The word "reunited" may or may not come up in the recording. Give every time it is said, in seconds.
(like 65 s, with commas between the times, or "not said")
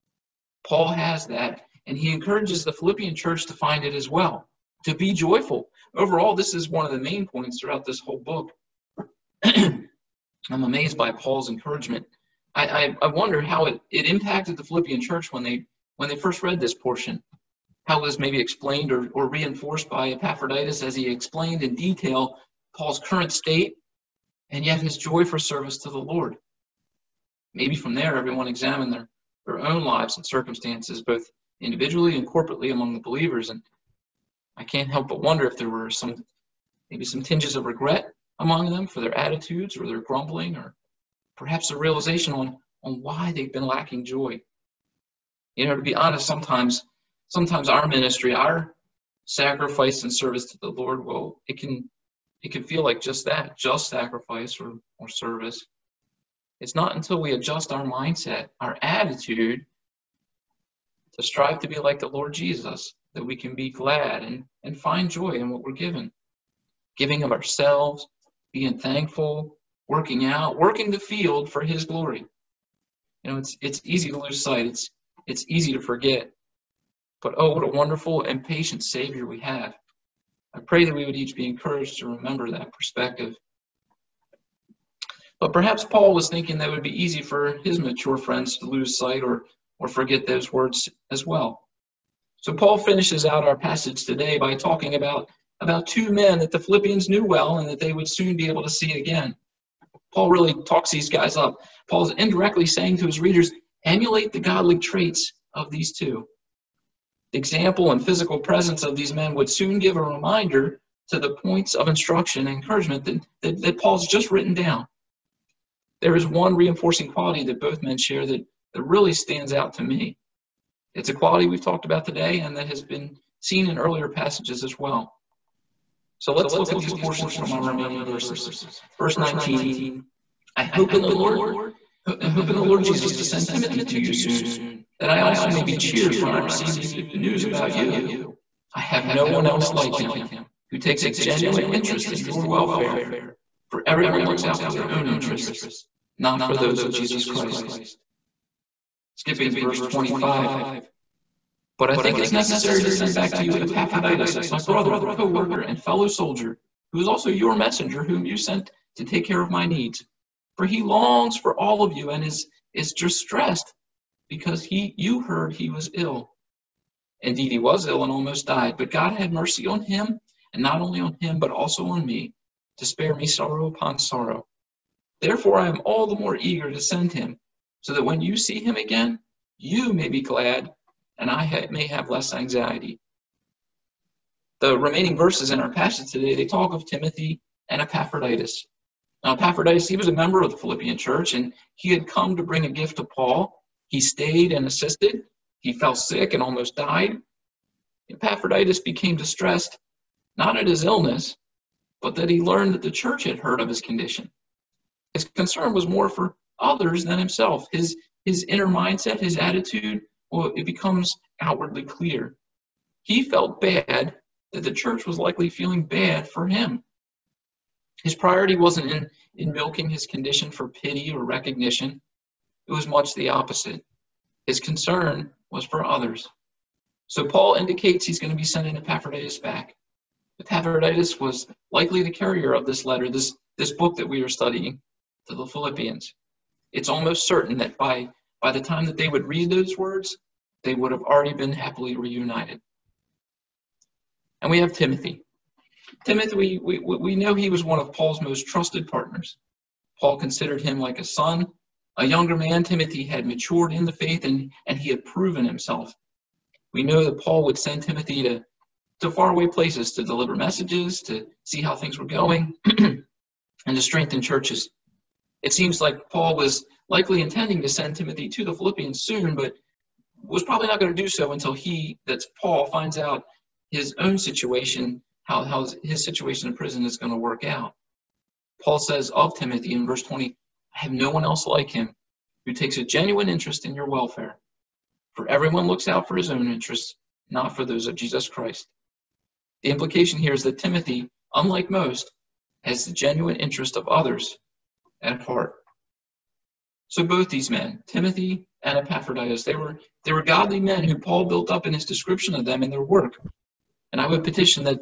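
241 s.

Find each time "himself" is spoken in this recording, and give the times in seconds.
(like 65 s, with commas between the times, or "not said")
207 s, 255 s.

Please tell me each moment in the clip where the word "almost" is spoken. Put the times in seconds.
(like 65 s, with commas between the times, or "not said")
168 s, 196 s, 236 s.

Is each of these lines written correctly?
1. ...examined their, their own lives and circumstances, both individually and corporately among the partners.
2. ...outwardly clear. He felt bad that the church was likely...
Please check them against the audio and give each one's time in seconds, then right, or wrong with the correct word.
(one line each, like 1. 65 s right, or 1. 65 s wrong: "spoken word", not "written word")
1. 28 s wrong: "believers", not "partners"
2. 211 s right.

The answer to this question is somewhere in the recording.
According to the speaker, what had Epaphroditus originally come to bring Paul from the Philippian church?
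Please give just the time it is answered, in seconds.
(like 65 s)
192 s.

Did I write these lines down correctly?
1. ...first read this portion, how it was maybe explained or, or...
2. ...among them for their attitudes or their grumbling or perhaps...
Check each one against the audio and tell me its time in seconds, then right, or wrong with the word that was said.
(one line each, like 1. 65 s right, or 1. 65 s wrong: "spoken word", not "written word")
1. 16 s right
2. 38 s right.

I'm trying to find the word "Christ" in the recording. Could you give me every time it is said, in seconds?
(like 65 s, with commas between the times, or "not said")
147 s, 288 s.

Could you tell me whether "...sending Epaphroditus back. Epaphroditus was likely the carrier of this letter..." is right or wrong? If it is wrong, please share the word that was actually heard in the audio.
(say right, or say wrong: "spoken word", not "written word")
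right.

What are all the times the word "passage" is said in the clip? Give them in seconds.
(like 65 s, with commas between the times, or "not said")
93 s, 124 s, 185 s.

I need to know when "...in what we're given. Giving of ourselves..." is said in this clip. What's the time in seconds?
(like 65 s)
65 s.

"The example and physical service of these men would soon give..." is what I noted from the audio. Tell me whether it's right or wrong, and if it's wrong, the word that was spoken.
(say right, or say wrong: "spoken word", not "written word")
wrong: "presence", not "service".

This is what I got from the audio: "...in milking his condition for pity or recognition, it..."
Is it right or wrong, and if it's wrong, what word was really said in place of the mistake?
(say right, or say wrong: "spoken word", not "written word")
right.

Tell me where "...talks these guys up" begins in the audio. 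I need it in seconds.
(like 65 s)
100 s.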